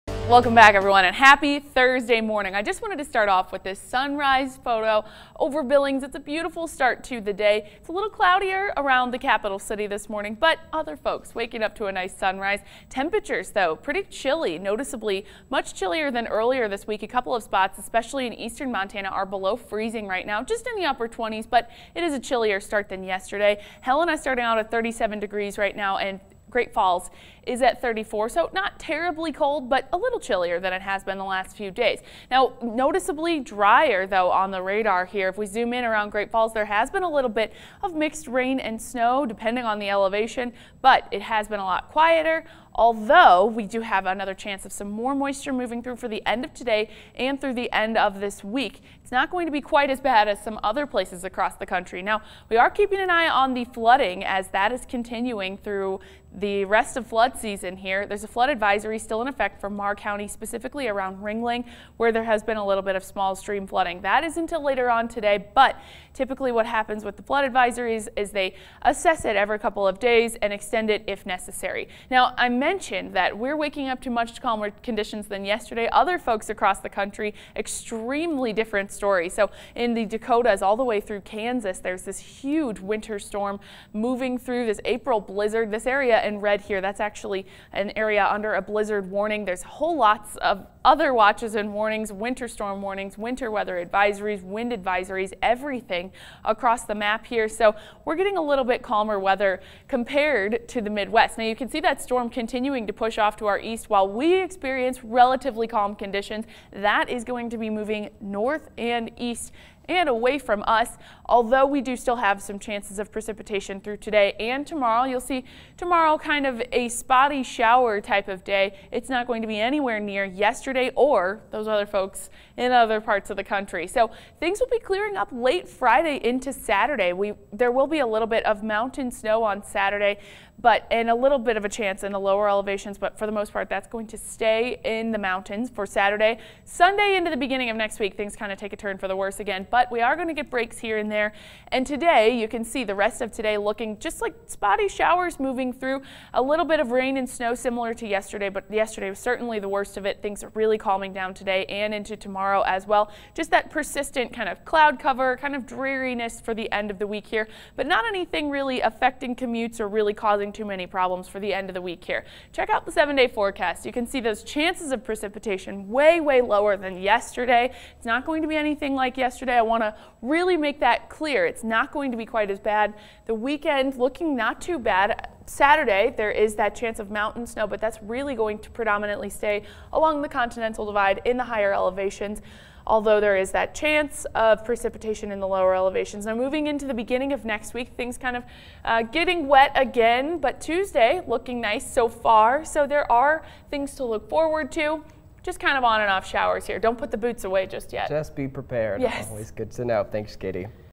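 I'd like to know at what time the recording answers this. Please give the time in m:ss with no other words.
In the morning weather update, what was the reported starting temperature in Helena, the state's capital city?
0:24.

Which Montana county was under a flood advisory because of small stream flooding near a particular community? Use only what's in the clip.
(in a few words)
Meagher County.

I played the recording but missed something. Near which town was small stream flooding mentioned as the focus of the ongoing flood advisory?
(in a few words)
Ringling.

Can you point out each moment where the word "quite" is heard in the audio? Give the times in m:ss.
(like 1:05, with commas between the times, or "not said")
0:49, 2:52.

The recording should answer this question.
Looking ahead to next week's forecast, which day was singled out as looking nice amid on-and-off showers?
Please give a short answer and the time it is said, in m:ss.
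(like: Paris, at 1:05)
Tuesday, at 3:10.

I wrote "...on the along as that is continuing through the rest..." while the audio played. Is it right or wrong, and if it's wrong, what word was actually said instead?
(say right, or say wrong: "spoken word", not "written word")
wrong: "flooding", not "along".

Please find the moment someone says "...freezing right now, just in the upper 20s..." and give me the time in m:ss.
0:19.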